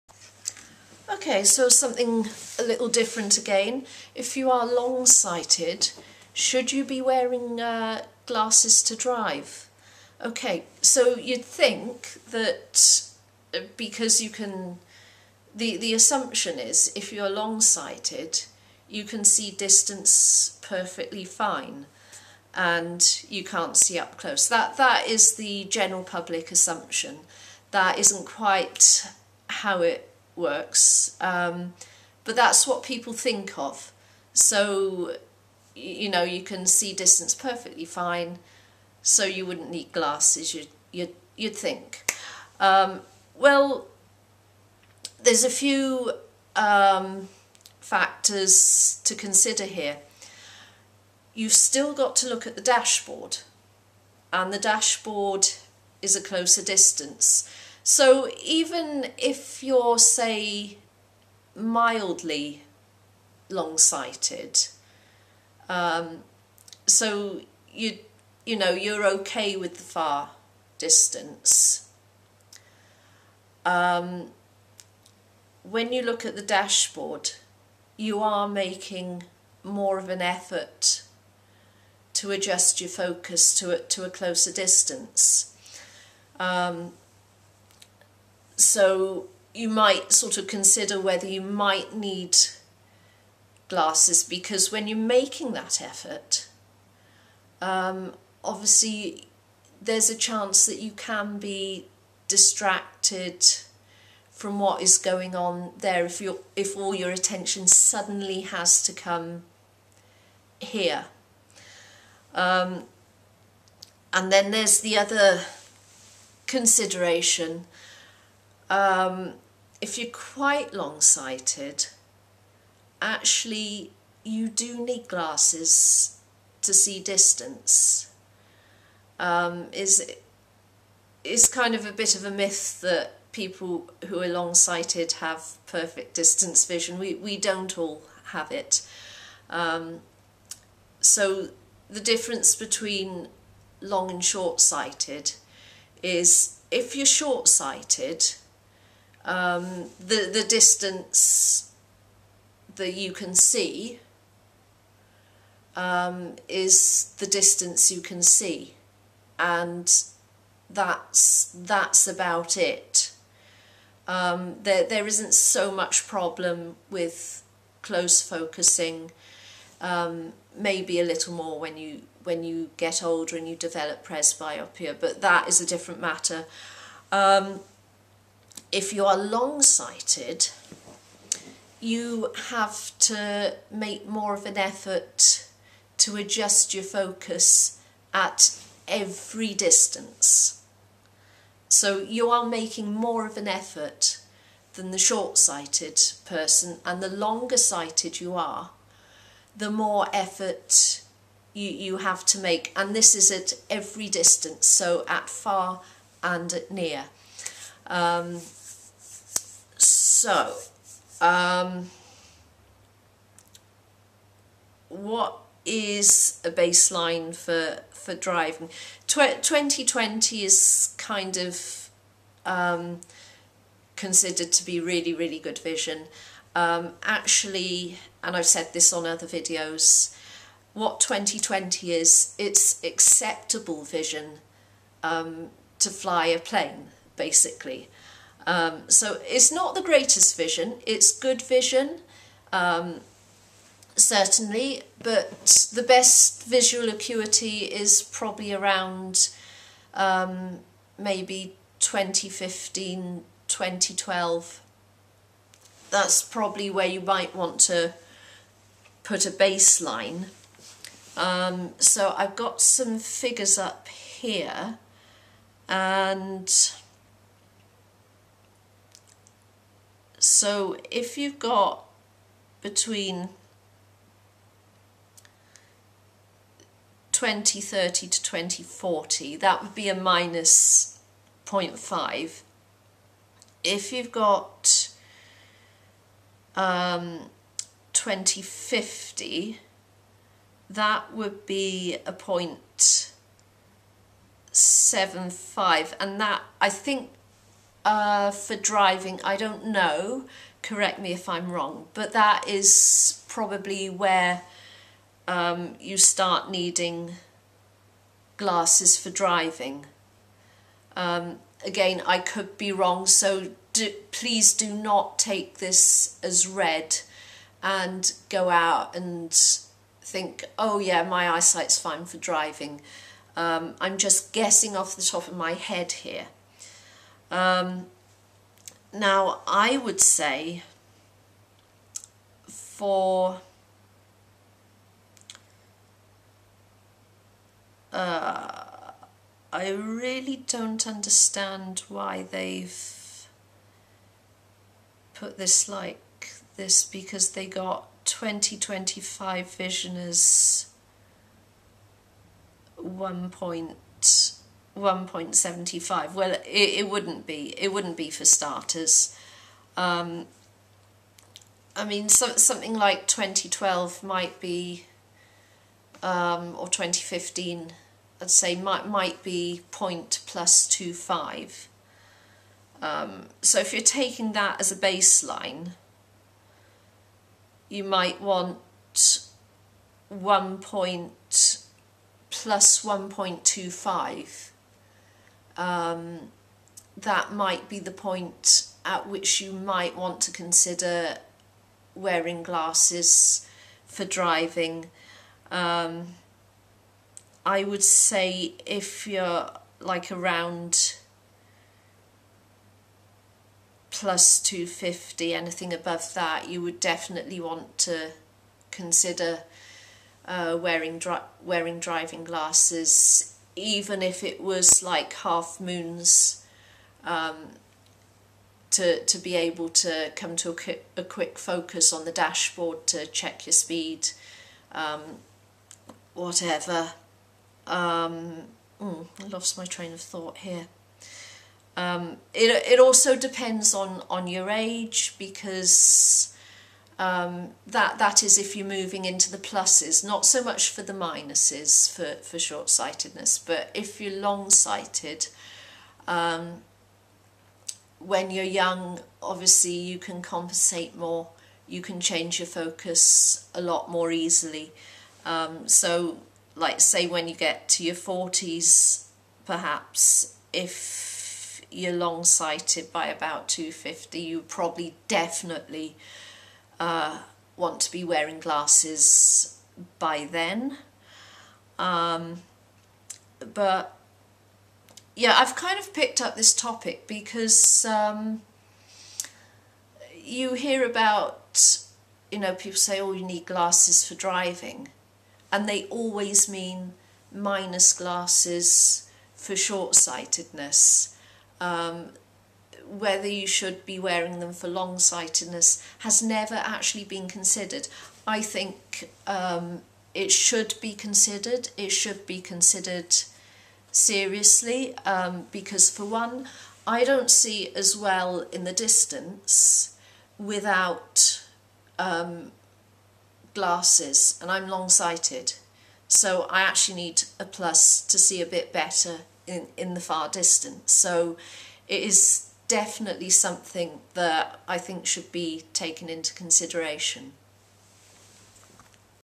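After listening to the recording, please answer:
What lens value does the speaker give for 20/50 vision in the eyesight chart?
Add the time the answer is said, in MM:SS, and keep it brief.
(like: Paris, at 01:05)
0.75, at 04:54.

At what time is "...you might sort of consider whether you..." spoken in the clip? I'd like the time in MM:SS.
01:29.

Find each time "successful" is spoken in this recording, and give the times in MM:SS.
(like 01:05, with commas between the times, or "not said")
not said.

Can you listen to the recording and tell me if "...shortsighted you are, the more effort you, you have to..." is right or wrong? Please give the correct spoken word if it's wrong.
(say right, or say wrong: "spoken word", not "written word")
wrong: "sighted", not "shortsighted".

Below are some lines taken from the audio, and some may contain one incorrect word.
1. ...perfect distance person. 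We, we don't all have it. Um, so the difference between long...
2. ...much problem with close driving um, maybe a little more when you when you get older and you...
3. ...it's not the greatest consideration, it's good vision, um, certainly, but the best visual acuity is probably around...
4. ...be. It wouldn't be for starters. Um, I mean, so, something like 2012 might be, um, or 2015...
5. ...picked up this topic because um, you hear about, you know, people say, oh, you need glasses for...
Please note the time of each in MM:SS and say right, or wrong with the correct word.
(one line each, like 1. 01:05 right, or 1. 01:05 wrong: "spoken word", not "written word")
1. 02:15 wrong: "vision", not "person"
2. 02:45 wrong: "focusing", not "driving"
3. 03:59 wrong: "vision", not "consideration"
4. 05:57 right
5. 07:55 right.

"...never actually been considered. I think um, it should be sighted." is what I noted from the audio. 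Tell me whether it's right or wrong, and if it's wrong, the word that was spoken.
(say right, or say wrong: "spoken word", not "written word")
wrong: "considered", not "sighted".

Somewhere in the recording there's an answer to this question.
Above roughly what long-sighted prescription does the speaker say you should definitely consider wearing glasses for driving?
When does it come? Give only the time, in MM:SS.
06:43.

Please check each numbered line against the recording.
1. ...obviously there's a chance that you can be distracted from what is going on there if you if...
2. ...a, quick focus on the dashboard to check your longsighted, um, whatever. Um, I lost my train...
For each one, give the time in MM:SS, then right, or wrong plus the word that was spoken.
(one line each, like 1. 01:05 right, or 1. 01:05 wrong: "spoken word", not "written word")
1. 01:38 right
2. 07:00 wrong: "speed", not "longsighted".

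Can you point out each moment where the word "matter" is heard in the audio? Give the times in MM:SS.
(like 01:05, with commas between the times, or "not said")
02:56.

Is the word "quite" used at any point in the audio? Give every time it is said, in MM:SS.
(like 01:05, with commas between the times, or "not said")
00:28, 02:00.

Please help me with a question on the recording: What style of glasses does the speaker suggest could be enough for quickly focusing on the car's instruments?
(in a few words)
half moons.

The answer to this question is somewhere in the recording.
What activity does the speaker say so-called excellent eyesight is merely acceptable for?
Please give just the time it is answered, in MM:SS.
03:55.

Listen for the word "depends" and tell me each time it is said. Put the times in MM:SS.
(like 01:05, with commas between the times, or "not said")
07:13.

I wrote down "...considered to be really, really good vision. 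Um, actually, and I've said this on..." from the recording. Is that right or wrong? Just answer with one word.
right.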